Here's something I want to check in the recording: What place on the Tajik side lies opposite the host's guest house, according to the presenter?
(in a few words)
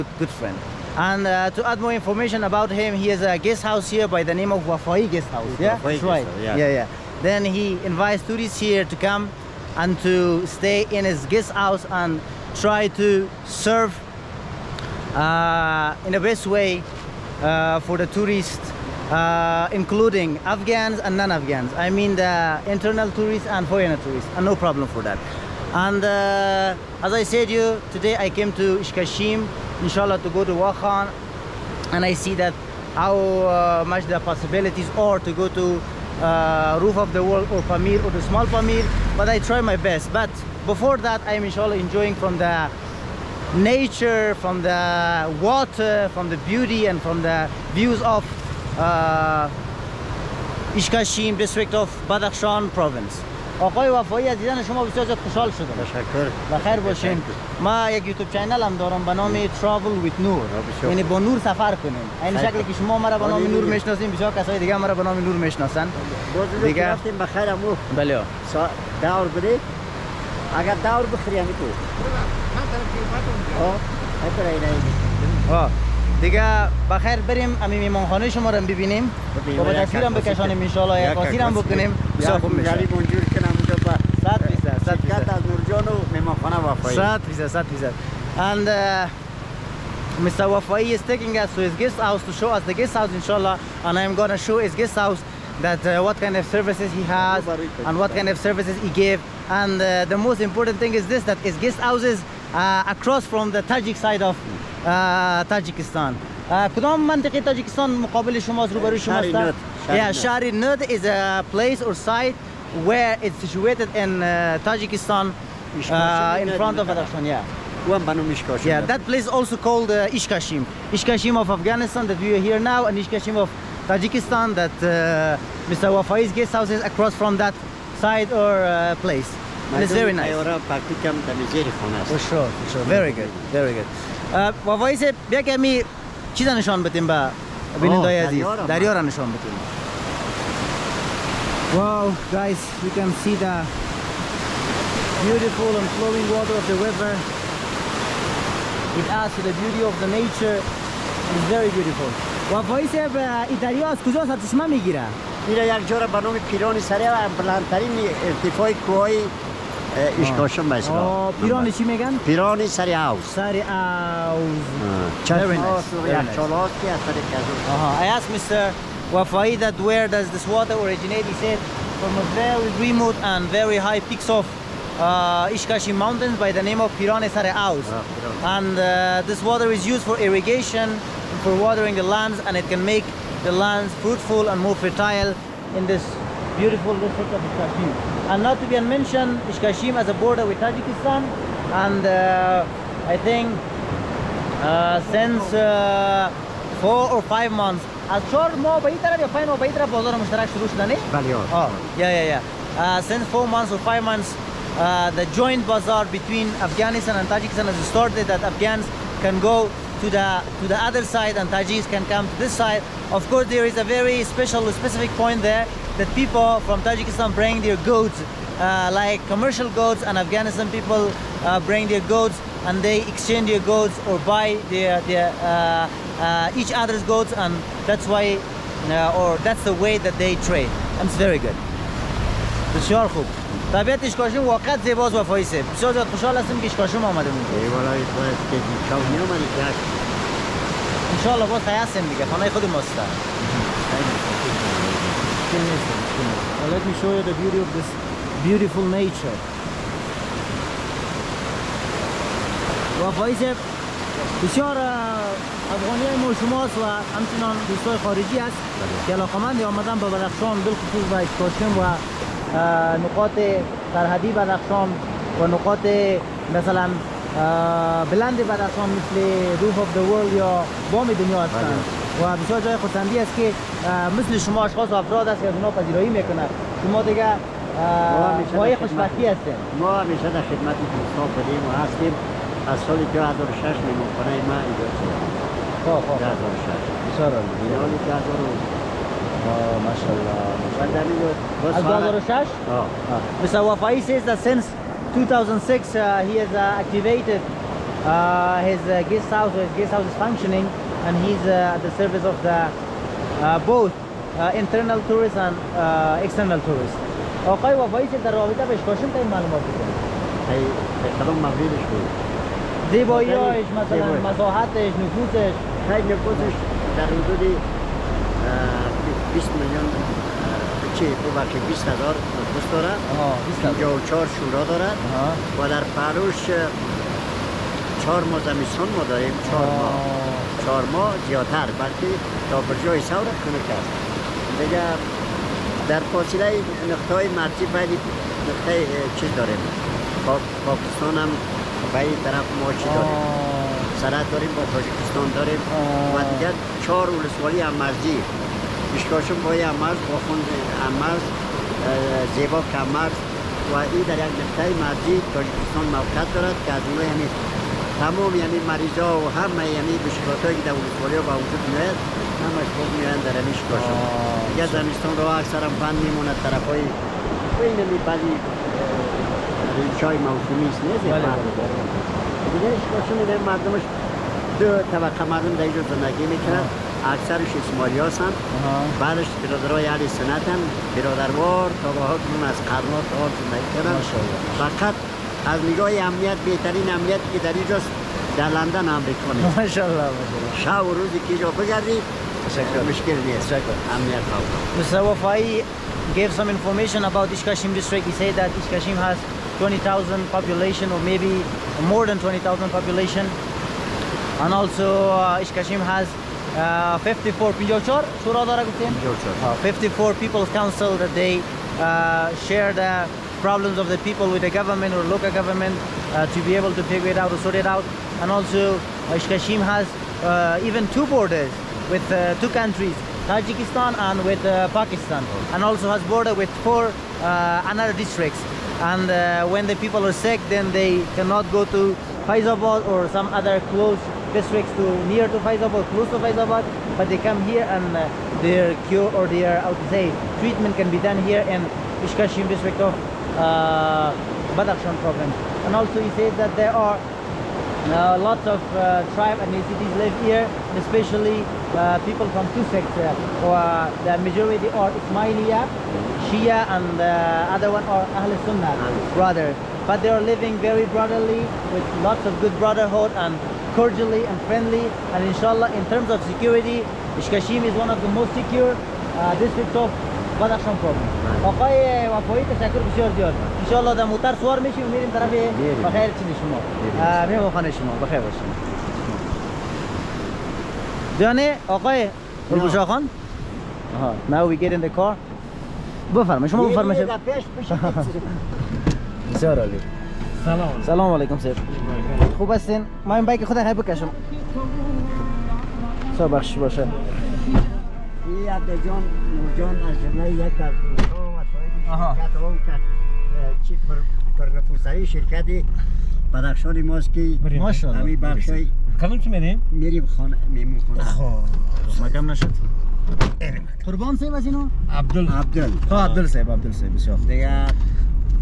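Shari Nud.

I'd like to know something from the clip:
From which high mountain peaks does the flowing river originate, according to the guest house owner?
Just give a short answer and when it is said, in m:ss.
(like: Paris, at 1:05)
Piran Sare Aus, at 2:56.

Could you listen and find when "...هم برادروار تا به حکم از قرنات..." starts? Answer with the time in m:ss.
6:20.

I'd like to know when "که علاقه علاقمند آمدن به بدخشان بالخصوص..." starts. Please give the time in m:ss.
4:19.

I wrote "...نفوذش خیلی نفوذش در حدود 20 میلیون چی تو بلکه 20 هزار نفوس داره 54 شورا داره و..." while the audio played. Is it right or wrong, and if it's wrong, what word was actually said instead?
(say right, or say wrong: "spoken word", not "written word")
right.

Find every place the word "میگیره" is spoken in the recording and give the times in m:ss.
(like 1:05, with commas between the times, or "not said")
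2:34.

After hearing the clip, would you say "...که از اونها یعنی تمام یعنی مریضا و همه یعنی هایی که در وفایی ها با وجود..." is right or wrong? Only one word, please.
wrong.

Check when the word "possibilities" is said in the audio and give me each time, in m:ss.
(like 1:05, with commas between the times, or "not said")
0:34.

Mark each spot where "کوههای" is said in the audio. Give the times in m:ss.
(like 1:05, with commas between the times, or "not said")
2:38.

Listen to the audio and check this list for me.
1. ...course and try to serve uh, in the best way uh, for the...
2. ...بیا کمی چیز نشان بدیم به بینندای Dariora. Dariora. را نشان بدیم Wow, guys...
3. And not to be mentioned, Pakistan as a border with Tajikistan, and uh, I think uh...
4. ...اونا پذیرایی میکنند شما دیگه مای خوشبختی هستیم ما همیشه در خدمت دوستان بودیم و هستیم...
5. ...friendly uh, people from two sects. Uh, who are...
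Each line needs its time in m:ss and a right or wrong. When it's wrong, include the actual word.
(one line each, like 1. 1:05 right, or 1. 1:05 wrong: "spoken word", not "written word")
1. 0:11 wrong: "house", not "course"
2. 2:15 right
3. 3:08 wrong: "Ishkashim", not "Pakistan"
4. 4:35 right
5. 7:30 wrong: "especially", not "friendly".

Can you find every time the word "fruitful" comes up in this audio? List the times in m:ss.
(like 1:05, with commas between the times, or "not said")
3:03.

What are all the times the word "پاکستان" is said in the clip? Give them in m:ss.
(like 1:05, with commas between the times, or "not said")
5:40.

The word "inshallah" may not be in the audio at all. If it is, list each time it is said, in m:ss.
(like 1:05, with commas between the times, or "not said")
0:29, 0:41, 1:33, 7:45.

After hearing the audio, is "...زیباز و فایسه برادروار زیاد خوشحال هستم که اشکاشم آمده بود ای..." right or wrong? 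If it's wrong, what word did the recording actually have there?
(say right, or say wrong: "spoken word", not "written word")
wrong: "بسیار", not "برادروار".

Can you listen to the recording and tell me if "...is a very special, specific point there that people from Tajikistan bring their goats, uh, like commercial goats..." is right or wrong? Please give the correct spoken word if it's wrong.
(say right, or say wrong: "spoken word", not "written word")
right.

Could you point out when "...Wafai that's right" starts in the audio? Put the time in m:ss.
0:05.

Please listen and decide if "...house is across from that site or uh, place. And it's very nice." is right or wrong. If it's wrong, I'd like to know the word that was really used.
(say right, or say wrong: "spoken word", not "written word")
right.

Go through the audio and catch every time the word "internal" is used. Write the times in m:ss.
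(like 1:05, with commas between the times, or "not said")
0:22, 5:04.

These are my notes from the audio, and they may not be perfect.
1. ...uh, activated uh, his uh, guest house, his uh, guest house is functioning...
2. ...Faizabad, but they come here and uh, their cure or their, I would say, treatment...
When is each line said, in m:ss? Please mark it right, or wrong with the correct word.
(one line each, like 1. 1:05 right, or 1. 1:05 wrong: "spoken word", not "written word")
1. 4:56 right
2. 7:16 right.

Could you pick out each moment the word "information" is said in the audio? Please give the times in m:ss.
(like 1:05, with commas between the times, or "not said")
0:01, 6:36.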